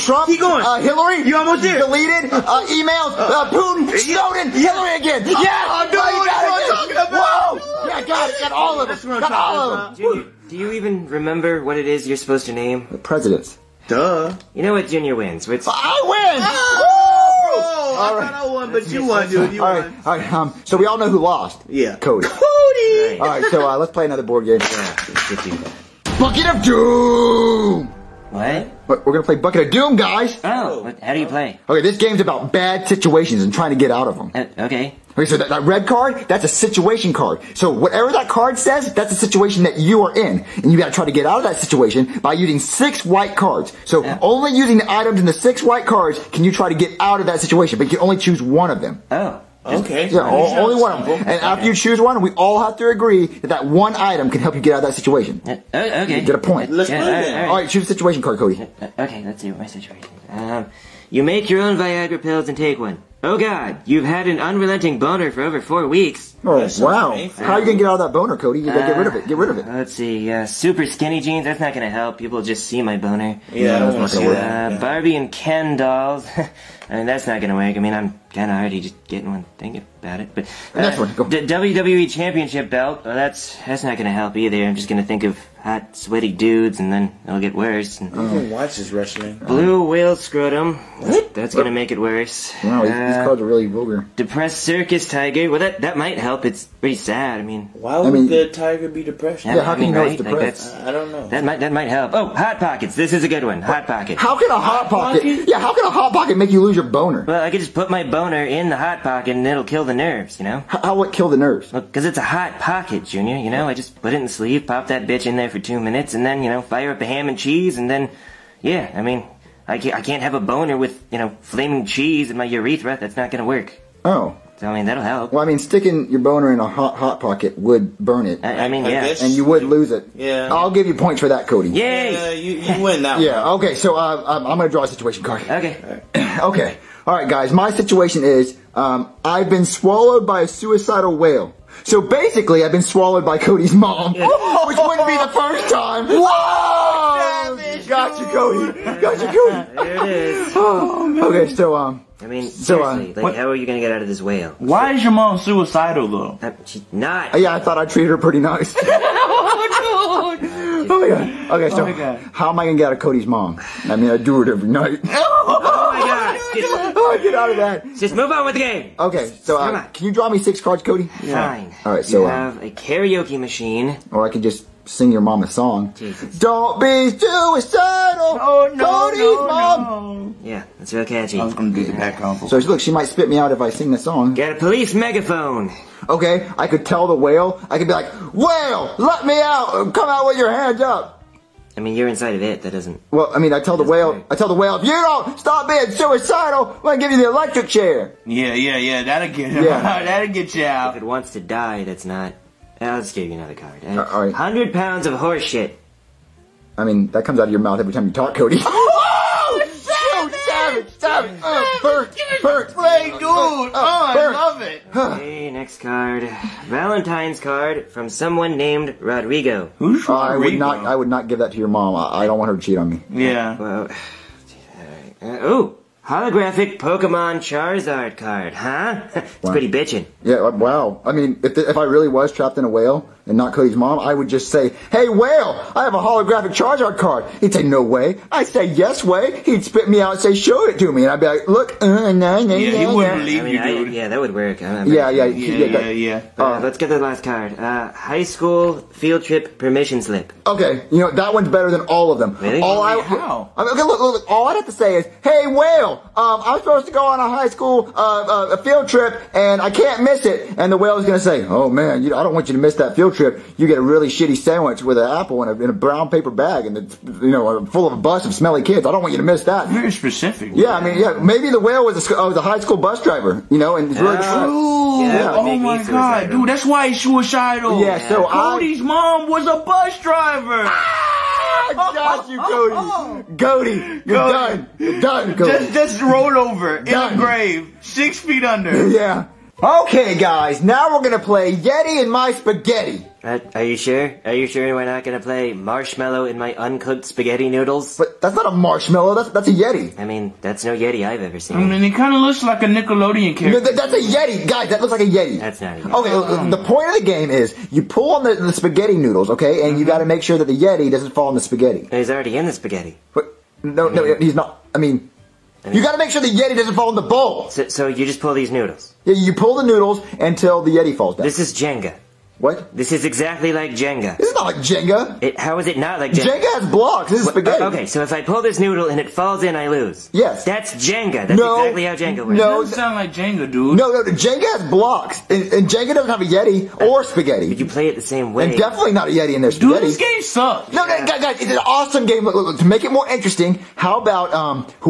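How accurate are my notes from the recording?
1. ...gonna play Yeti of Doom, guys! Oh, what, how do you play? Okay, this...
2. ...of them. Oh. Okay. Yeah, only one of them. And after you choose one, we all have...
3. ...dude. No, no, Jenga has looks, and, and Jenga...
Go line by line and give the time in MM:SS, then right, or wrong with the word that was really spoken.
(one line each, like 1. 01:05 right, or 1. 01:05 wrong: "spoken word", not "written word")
1. 00:29 wrong: "Bucket", not "Yeti"
2. 00:48 right
3. 05:33 wrong: "blocks", not "looks".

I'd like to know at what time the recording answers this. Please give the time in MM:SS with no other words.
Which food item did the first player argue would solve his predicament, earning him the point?
01:42.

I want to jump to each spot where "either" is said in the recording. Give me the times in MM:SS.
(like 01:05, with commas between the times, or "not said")
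01:24.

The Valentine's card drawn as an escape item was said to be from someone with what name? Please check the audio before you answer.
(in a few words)
Rodrigo.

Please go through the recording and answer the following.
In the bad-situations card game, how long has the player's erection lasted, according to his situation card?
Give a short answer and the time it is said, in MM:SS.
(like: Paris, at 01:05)
over 4 weeks, at 01:05.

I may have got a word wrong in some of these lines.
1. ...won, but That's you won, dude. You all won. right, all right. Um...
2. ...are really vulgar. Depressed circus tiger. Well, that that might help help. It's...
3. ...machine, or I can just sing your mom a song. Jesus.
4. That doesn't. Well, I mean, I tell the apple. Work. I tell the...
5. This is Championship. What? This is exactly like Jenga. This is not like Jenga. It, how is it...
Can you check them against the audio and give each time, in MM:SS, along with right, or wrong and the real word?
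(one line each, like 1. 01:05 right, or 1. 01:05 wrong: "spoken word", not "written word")
1. 00:18 right
2. 01:33 right
3. 02:53 right
4. 03:12 wrong: "whale", not "apple"
5. 05:21 wrong: "Jenga", not "Championship".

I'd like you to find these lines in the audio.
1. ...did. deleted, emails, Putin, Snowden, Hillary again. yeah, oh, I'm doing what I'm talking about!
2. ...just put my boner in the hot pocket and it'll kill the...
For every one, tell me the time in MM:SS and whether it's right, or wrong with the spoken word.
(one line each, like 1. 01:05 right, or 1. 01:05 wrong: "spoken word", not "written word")
1. 00:01 right
2. 01:47 right.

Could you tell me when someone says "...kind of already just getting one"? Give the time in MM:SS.
01:18.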